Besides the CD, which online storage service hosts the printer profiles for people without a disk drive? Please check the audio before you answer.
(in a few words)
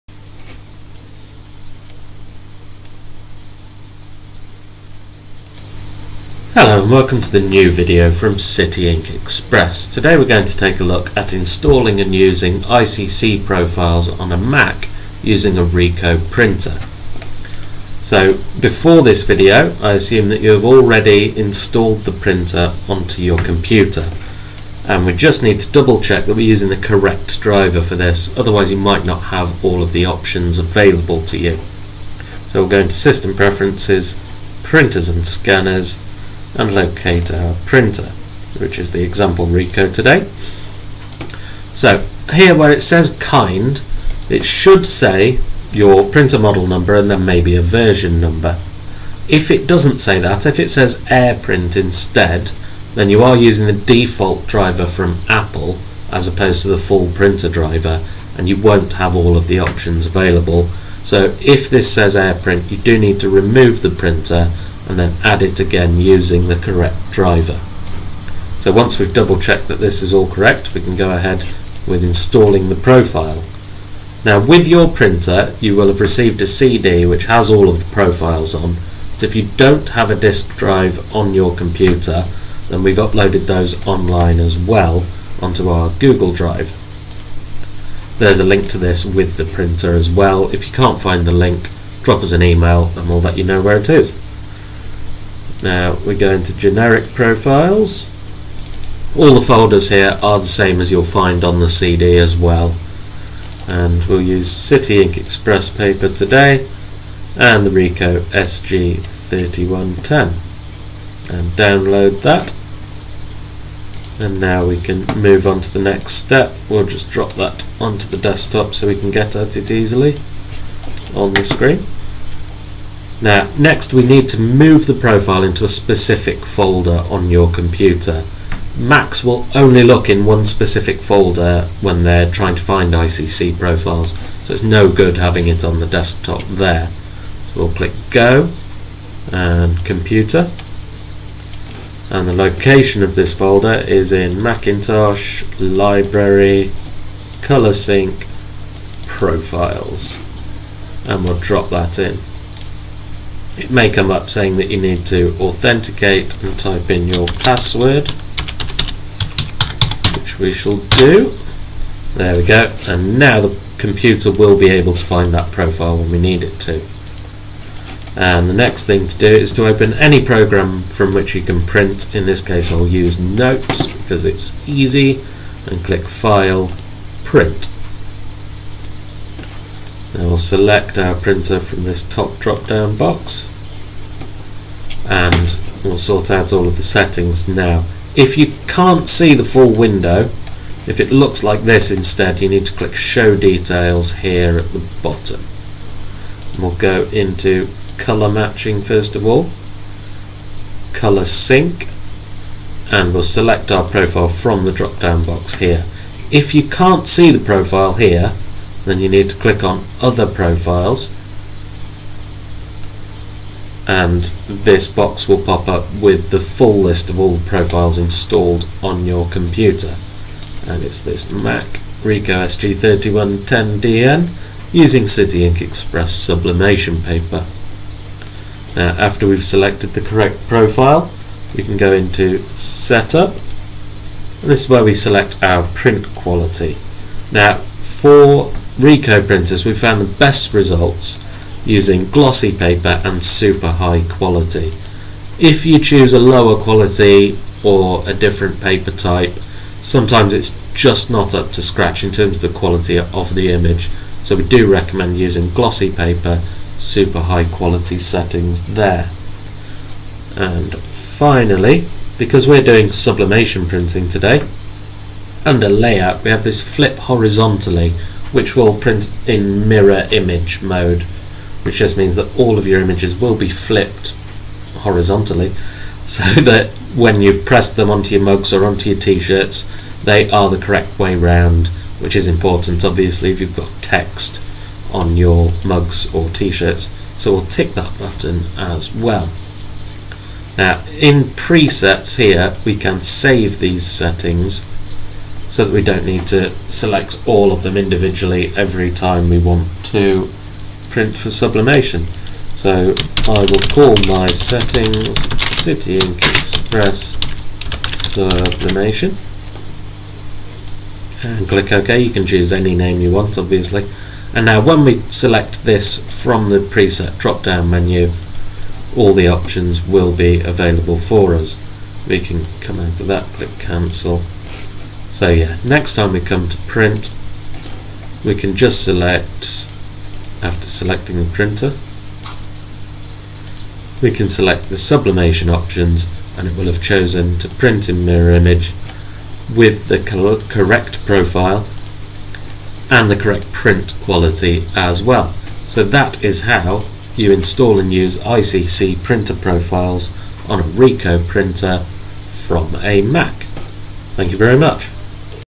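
Google Drive.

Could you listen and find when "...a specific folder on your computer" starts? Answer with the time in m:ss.
2:05.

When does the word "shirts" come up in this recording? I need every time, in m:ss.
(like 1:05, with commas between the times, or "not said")
4:38, 4:46.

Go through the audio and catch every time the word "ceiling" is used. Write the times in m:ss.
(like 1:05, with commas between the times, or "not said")
not said.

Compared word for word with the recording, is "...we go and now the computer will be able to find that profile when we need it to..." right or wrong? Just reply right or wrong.
right.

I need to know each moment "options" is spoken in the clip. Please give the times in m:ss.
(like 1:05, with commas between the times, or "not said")
0:30, 0:59, 5:19, 5:35.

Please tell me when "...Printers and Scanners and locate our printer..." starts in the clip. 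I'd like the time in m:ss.
0:34.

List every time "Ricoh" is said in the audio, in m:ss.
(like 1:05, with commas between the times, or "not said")
0:15, 0:39, 1:47, 3:42, 3:58, 5:50.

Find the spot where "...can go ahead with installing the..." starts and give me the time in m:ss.
1:10.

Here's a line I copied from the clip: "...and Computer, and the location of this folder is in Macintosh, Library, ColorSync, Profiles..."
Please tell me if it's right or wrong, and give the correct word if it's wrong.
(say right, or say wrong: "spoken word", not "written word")
right.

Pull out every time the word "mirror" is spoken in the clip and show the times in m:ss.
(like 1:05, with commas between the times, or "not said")
4:29, 5:38.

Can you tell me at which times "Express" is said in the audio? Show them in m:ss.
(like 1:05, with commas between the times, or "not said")
0:09, 1:45, 3:45, 5:06.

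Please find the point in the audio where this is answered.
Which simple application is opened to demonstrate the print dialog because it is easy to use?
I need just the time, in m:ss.
2:53.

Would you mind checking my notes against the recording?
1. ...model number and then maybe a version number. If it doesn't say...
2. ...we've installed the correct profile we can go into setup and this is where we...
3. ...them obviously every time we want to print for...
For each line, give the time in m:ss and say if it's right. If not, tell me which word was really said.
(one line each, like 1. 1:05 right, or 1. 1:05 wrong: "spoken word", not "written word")
1. 0:46 right
2. 3:49 wrong: "selected", not "installed"
3. 4:57 wrong: "individually", not "obviously".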